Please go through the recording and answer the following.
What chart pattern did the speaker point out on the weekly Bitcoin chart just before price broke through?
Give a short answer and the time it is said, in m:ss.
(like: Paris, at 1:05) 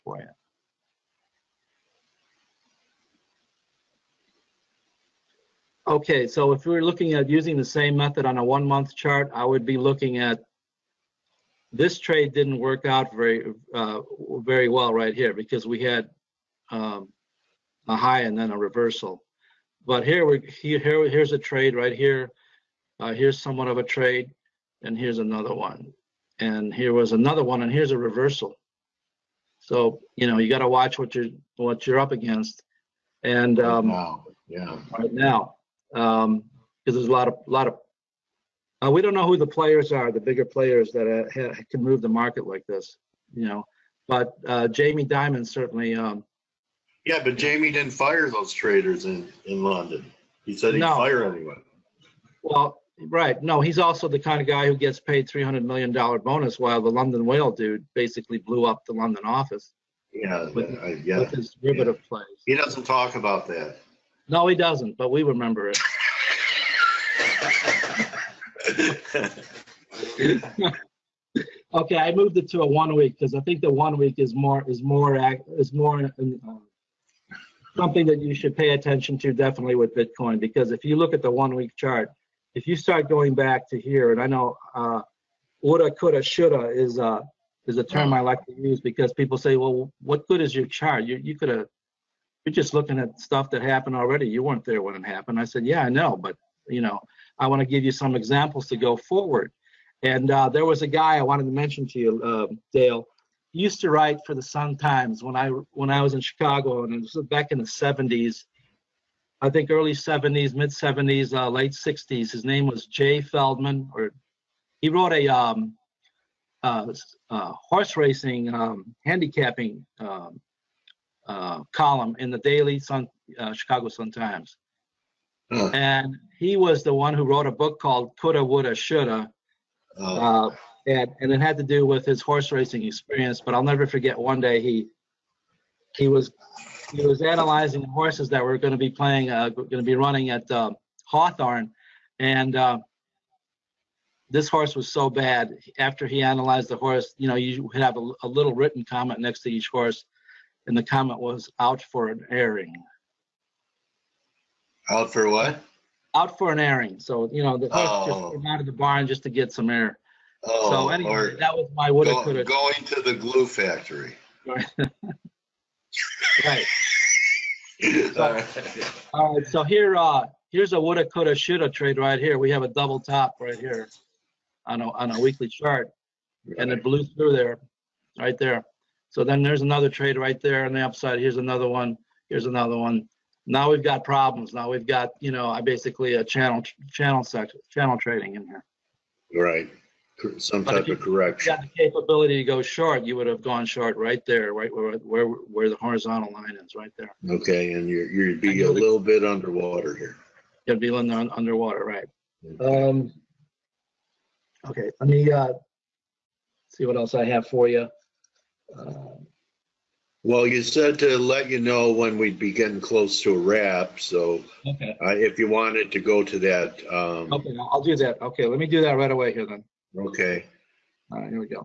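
Double top, at 2:52.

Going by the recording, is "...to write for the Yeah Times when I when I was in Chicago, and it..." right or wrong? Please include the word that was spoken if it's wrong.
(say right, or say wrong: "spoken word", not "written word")
wrong: "Sun", not "Yeah".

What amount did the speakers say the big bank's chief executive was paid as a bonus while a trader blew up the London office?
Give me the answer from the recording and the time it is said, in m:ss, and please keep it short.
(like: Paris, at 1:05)
$300 million, at 0:55.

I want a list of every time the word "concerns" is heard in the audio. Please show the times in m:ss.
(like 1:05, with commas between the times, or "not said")
not said.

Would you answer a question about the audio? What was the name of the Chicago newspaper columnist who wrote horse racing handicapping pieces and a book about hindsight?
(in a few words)
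Jay Feldman.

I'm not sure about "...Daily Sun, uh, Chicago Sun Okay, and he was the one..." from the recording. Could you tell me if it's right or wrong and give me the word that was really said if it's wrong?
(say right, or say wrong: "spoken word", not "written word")
wrong: "Times", not "Okay".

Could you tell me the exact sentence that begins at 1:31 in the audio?
You you could have you're just looking at stuff that happened already.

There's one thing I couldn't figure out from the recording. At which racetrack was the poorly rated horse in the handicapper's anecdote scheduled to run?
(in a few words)
Hawthorne.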